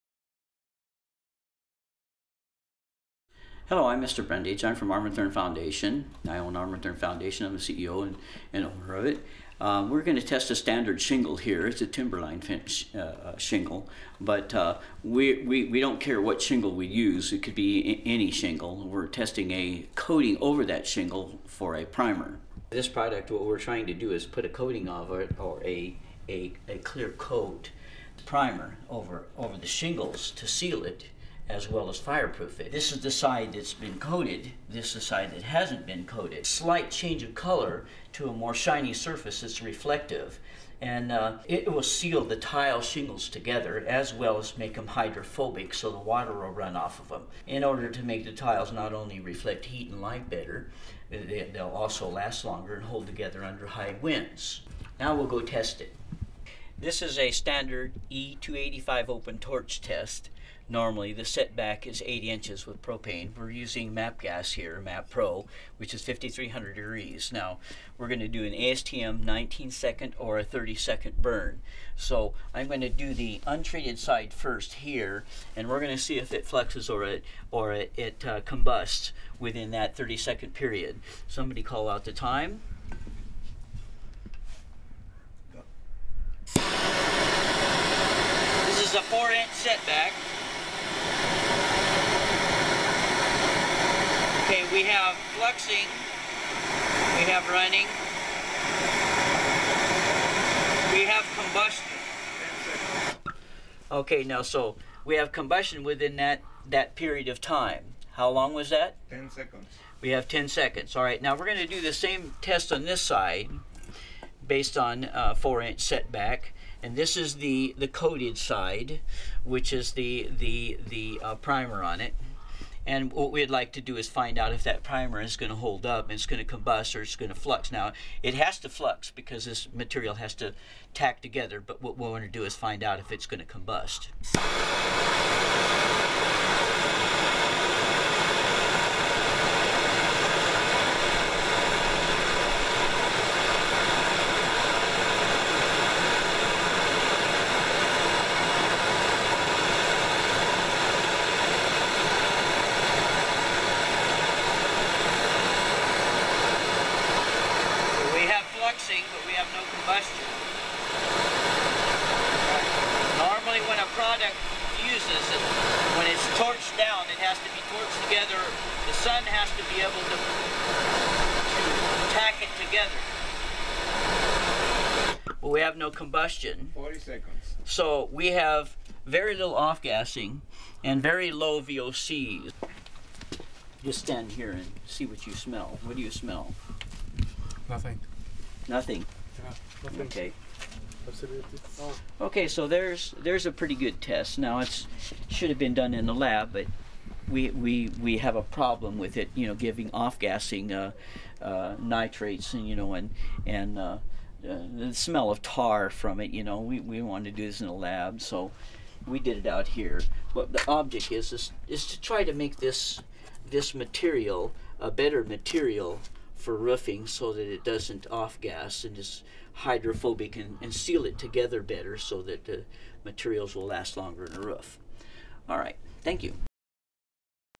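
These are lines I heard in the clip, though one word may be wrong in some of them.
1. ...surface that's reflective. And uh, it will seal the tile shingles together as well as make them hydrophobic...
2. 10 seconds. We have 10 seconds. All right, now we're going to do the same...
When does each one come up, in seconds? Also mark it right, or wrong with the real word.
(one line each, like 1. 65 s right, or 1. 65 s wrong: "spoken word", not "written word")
1. 38 s right
2. 109 s right.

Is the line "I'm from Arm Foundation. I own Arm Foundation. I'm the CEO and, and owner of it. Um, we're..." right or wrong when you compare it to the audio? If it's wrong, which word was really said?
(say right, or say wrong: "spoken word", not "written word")
right.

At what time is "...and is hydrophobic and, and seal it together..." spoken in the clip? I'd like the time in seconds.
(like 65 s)
218 s.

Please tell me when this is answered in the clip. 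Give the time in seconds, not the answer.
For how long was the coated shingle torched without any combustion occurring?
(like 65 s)
176 s.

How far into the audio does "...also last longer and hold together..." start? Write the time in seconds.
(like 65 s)
51 s.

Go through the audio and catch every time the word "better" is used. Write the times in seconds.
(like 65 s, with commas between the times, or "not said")
50 s, 214 s, 221 s.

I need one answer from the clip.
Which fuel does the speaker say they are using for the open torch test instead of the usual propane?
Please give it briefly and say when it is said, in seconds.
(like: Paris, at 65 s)
MAP gas, at 63 s.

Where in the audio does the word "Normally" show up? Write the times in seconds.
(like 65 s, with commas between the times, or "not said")
60 s, 163 s.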